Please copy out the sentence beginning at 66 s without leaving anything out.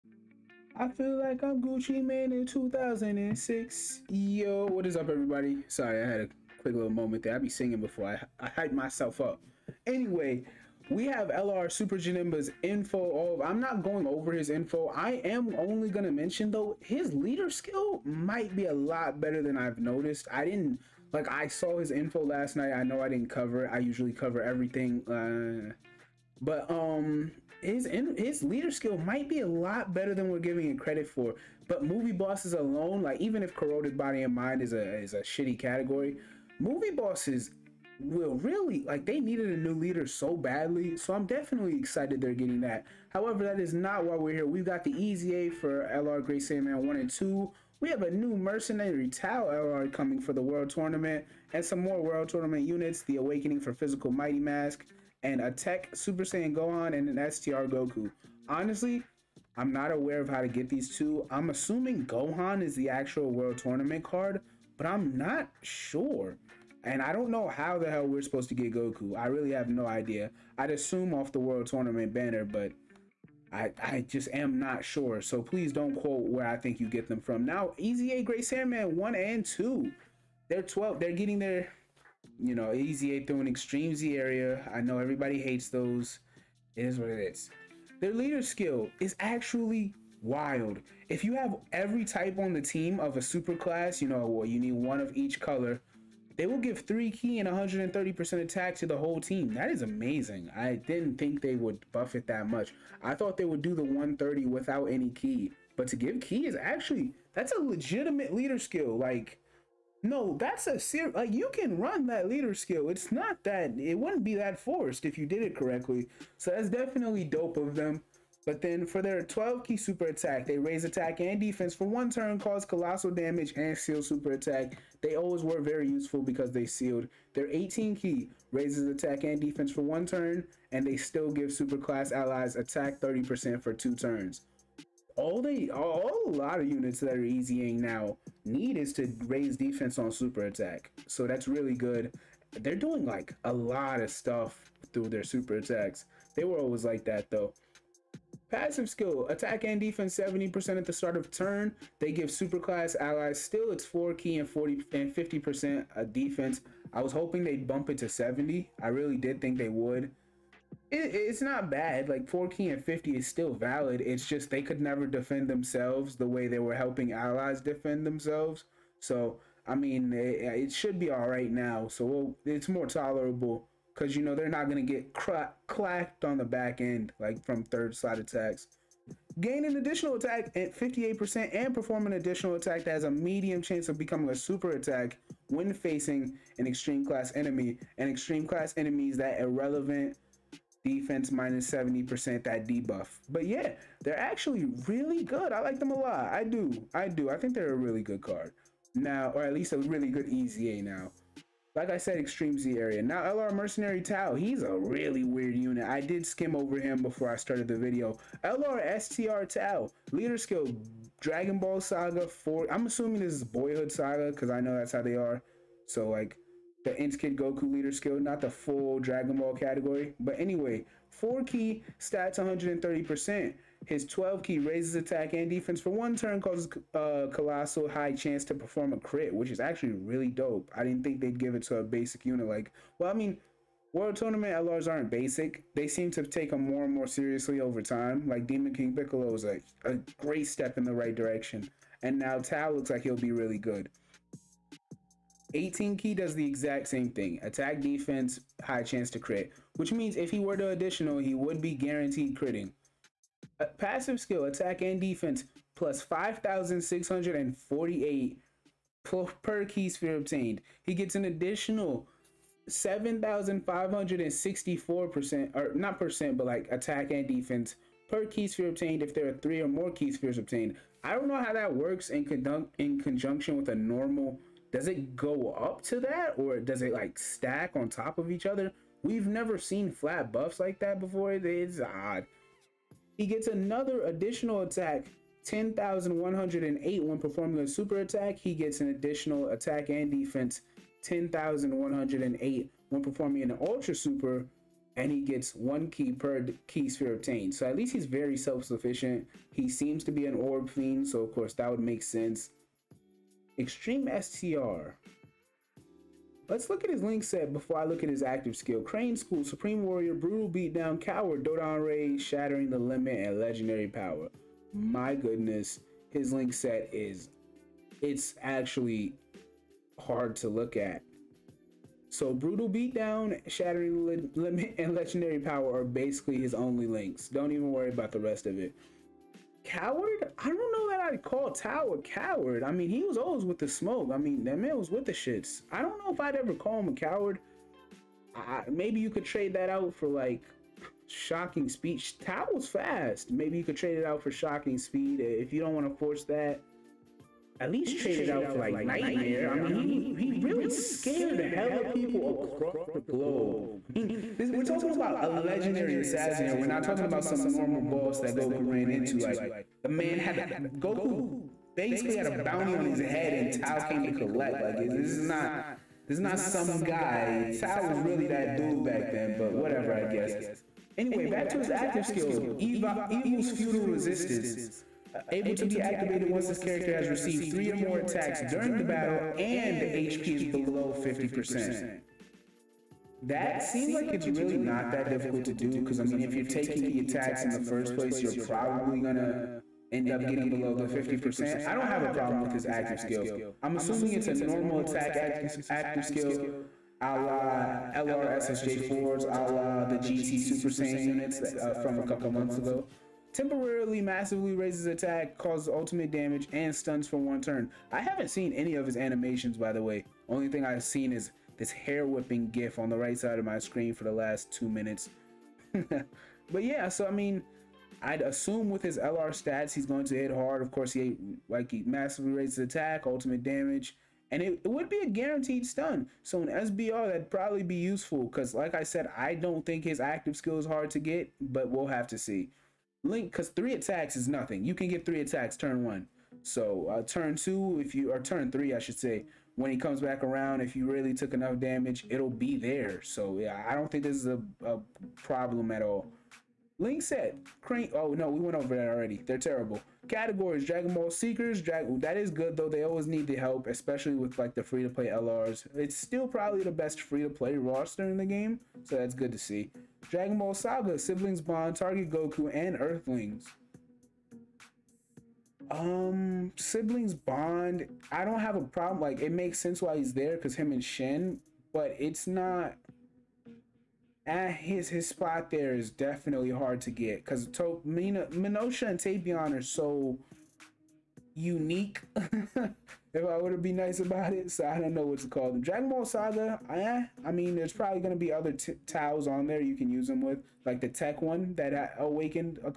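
And I don't know how the hell we're supposed to get Goku.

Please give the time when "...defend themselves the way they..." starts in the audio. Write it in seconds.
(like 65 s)
165 s.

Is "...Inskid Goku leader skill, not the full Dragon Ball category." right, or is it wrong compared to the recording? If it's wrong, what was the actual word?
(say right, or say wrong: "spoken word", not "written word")
right.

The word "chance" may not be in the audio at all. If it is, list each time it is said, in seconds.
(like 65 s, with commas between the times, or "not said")
183 s, 228 s, 248 s.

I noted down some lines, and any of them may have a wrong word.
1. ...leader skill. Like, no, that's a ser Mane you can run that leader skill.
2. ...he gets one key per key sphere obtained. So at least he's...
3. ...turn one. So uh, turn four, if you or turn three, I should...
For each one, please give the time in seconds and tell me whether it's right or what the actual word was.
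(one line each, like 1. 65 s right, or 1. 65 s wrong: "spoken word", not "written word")
1. 108 s wrong: "Like", not "Mane"
2. 295 s right
3. 435 s wrong: "two", not "four".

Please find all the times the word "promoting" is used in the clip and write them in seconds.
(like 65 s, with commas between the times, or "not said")
not said.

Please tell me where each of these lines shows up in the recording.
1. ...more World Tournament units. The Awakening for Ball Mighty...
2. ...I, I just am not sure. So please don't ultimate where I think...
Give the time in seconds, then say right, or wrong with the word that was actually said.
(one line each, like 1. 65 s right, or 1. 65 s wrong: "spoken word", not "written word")
1. 51 s wrong: "Physical", not "Ball"
2. 73 s wrong: "quote", not "ultimate".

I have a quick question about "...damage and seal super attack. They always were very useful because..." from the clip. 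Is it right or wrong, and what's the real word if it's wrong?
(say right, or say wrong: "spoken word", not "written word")
right.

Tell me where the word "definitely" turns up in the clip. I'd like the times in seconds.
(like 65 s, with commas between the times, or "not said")
41 s, 116 s, 475 s.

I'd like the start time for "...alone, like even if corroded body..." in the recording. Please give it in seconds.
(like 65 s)
32 s.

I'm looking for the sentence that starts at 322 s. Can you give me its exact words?
So Brutal Beatdown, Shattering the Limit, and Legendary Power are basically his only links.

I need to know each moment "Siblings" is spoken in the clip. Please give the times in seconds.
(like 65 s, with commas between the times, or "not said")
460 s, 466 s.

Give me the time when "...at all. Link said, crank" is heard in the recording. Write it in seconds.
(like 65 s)
445 s.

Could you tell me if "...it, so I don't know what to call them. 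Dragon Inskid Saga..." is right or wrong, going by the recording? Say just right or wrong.
wrong.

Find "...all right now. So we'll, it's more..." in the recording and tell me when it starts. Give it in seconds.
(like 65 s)
171 s.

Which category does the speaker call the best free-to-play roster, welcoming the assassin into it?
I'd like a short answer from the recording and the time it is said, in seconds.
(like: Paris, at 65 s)
Dragon Ball Seekers, at 450 s.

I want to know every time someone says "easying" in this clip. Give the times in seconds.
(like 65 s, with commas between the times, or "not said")
137 s.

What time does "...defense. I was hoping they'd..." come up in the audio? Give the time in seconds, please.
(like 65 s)
156 s.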